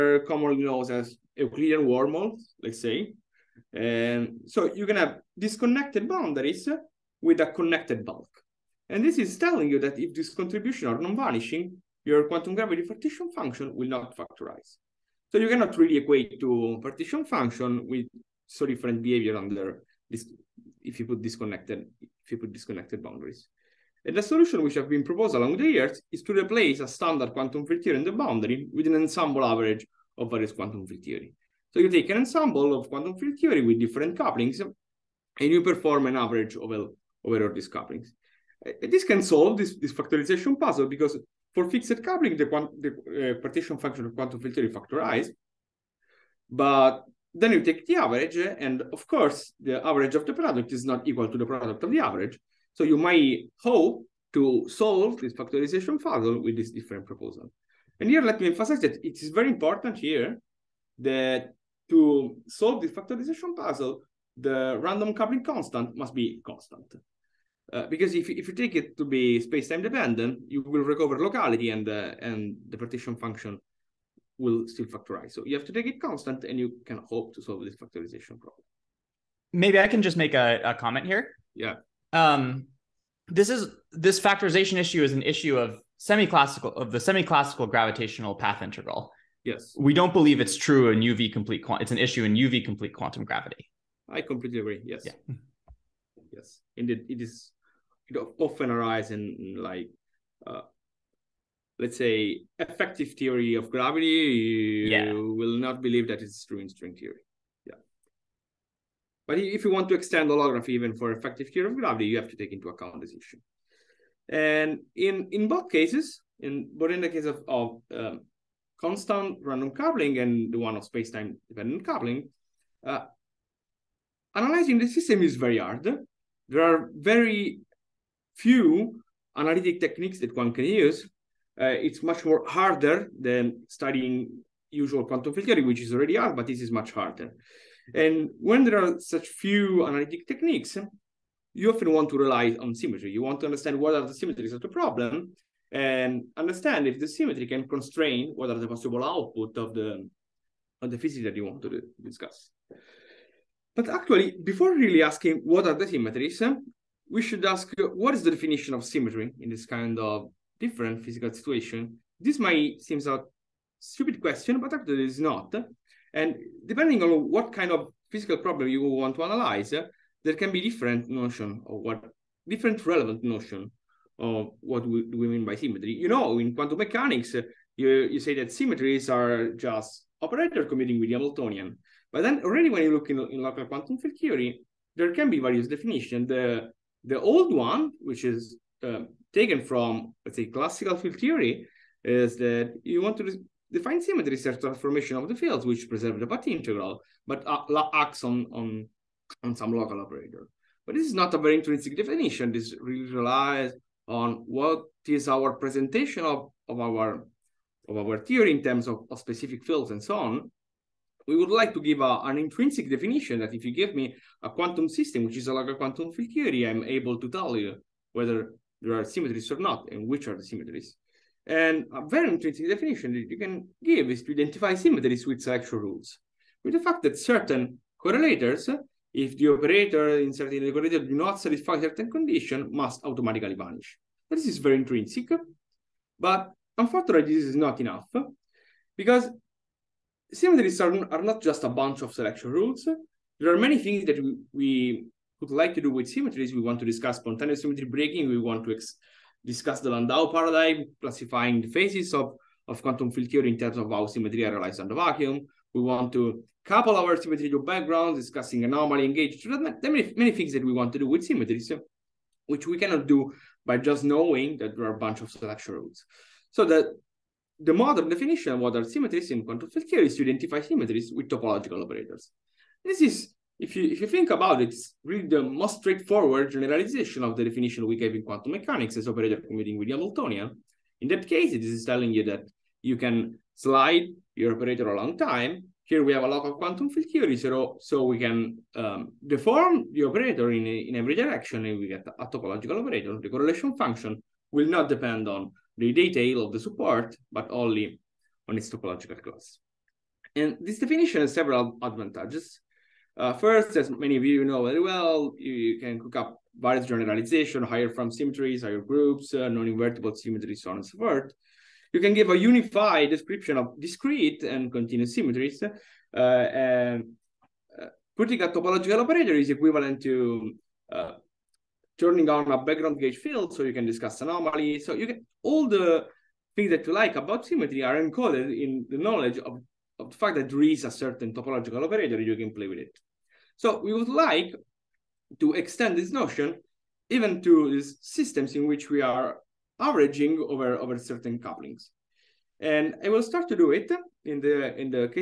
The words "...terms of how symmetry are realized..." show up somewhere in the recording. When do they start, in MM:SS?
04:13.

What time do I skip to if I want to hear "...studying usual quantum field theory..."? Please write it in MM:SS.
02:13.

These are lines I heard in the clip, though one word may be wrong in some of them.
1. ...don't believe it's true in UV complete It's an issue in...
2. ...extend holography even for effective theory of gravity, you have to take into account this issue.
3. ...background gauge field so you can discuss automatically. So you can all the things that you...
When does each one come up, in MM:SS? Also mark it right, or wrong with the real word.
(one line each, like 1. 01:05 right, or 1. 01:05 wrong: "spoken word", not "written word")
1. 01:29 right
2. 01:49 right
3. 05:22 wrong: "anomaly", not "automatically".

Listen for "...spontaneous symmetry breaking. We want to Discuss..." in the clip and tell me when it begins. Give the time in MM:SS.
04:07.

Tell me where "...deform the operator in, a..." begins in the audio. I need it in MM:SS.
04:49.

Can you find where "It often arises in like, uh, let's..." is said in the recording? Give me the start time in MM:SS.
01:38.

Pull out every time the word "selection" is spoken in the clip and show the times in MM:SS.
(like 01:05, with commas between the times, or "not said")
03:45, 04:02, 04:25.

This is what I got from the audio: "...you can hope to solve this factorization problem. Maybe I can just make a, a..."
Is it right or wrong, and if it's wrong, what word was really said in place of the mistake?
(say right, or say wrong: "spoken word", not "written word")
right.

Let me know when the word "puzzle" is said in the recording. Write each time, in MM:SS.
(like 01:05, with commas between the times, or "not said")
00:40, 00:55, 01:03.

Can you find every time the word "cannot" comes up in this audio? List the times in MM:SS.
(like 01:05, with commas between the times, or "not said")
00:15, 04:22.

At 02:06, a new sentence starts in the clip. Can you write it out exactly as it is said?
There are very few analytic techniques that one can use.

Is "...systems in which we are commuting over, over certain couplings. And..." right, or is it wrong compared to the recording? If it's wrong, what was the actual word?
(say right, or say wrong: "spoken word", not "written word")
wrong: "averaging", not "commuting".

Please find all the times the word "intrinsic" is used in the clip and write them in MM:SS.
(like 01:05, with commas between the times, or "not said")
03:21, 03:32, 03:54.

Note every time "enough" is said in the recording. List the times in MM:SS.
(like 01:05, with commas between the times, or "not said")
03:57.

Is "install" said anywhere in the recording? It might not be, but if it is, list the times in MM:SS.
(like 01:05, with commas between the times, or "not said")
not said.